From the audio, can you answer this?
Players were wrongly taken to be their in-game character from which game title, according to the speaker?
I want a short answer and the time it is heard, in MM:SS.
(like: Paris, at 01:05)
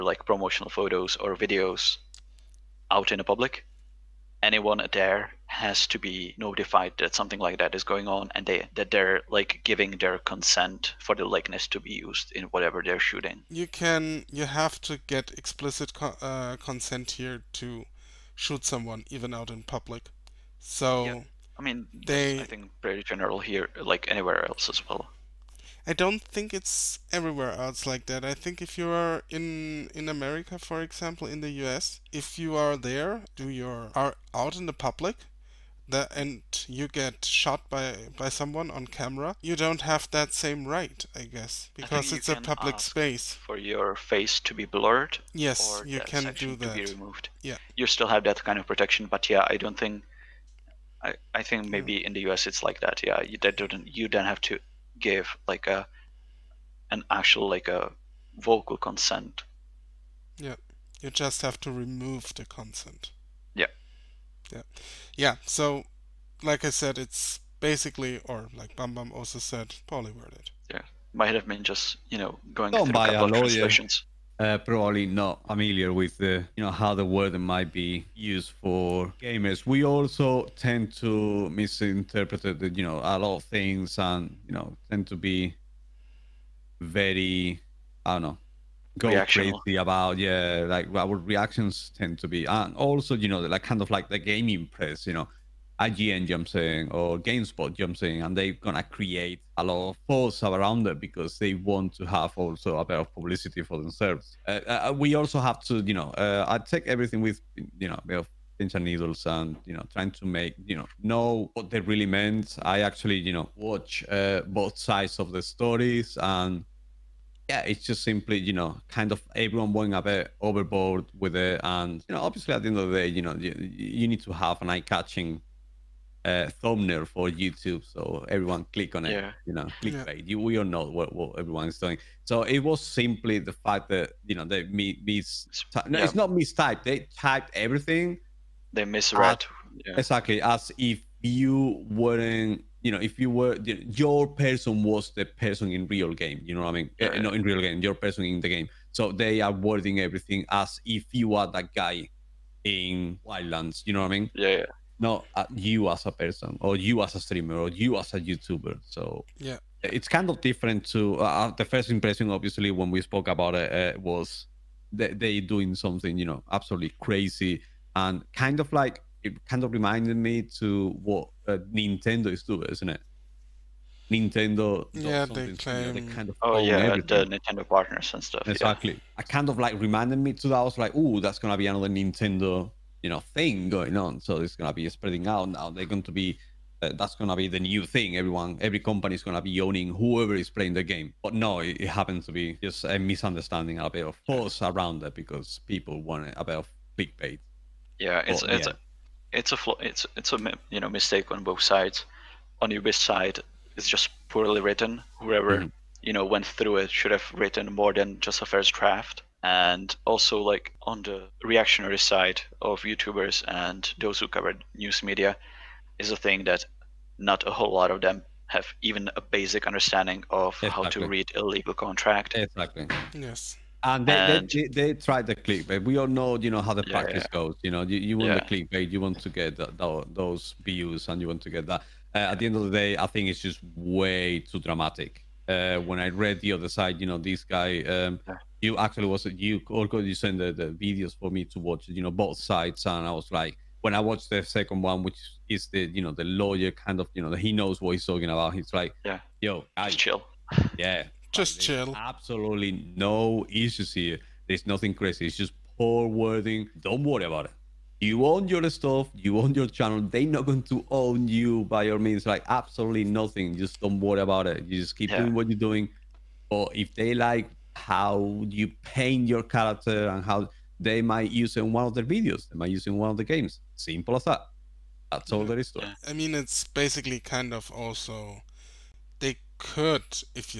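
Wildlands, at 02:33.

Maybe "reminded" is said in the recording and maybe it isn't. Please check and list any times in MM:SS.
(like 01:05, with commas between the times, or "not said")
02:49, 02:59.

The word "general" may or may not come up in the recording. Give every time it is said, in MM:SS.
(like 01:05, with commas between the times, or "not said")
00:23.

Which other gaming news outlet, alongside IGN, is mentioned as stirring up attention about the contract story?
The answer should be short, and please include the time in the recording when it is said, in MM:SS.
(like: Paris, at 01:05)
GameSpot, at 01:37.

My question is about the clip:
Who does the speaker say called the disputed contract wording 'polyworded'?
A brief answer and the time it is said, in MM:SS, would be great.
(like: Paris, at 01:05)
Bam Bam, at 01:08.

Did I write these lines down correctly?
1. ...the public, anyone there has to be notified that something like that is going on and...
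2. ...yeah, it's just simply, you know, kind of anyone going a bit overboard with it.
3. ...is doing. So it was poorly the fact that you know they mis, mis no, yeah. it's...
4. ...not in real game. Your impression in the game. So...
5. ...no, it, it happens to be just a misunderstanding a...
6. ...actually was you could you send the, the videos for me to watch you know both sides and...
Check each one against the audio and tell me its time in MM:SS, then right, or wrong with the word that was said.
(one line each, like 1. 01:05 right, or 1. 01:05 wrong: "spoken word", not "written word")
1. 00:03 right
2. 01:57 wrong: "everyone", not "anyone"
3. 02:11 wrong: "simply", not "poorly"
4. 02:27 wrong: "person", not "impression"
5. 03:11 right
6. 03:58 right.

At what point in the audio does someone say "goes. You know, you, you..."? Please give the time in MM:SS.
03:47.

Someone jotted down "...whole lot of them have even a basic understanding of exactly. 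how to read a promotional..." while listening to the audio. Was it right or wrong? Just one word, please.
wrong.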